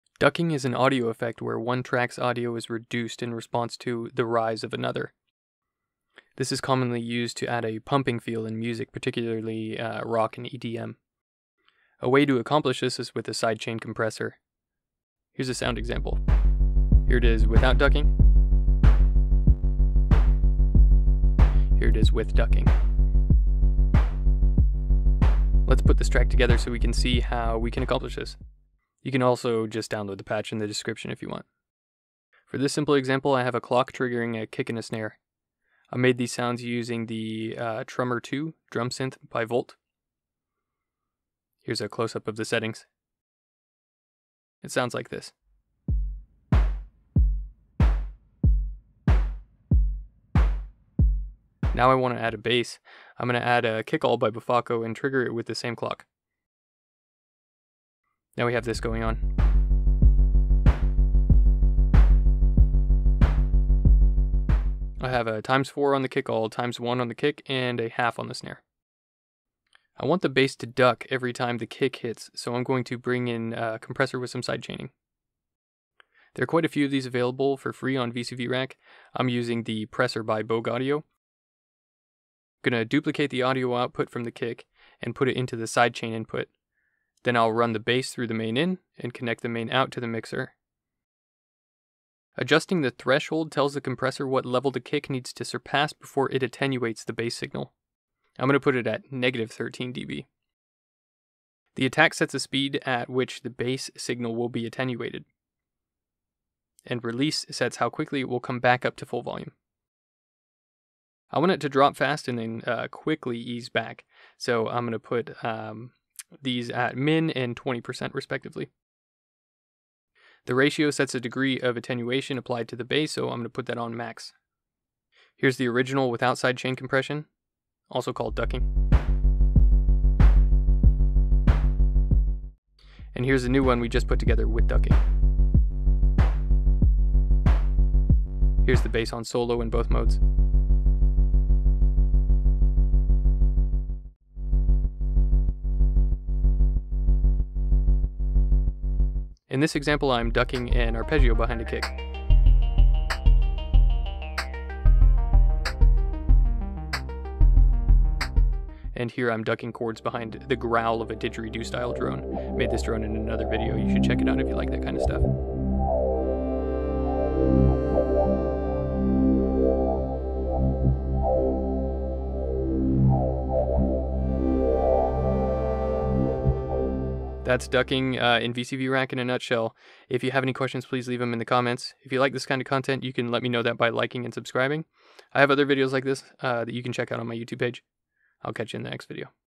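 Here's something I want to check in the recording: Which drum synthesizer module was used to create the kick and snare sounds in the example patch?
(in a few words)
Trummor 2.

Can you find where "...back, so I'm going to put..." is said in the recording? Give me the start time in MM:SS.
01:53.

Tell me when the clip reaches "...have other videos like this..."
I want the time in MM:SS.
03:05.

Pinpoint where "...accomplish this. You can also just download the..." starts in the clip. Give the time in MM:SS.
00:27.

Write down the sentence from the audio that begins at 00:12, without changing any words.
A way to accomplish this is with a sidechain compressor.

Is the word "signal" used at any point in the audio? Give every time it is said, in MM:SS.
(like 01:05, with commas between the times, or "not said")
01:37, 01:43.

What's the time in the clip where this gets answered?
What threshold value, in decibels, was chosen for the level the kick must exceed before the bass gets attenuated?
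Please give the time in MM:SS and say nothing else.
01:39.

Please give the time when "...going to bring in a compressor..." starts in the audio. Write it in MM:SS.
01:12.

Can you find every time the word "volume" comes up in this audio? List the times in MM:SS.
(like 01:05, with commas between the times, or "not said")
01:49.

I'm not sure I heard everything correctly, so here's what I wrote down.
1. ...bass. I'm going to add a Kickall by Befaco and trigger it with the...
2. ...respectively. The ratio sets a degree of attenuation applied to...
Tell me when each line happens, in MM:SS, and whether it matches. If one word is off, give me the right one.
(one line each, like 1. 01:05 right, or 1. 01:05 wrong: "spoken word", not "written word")
1. 00:52 right
2. 01:58 right.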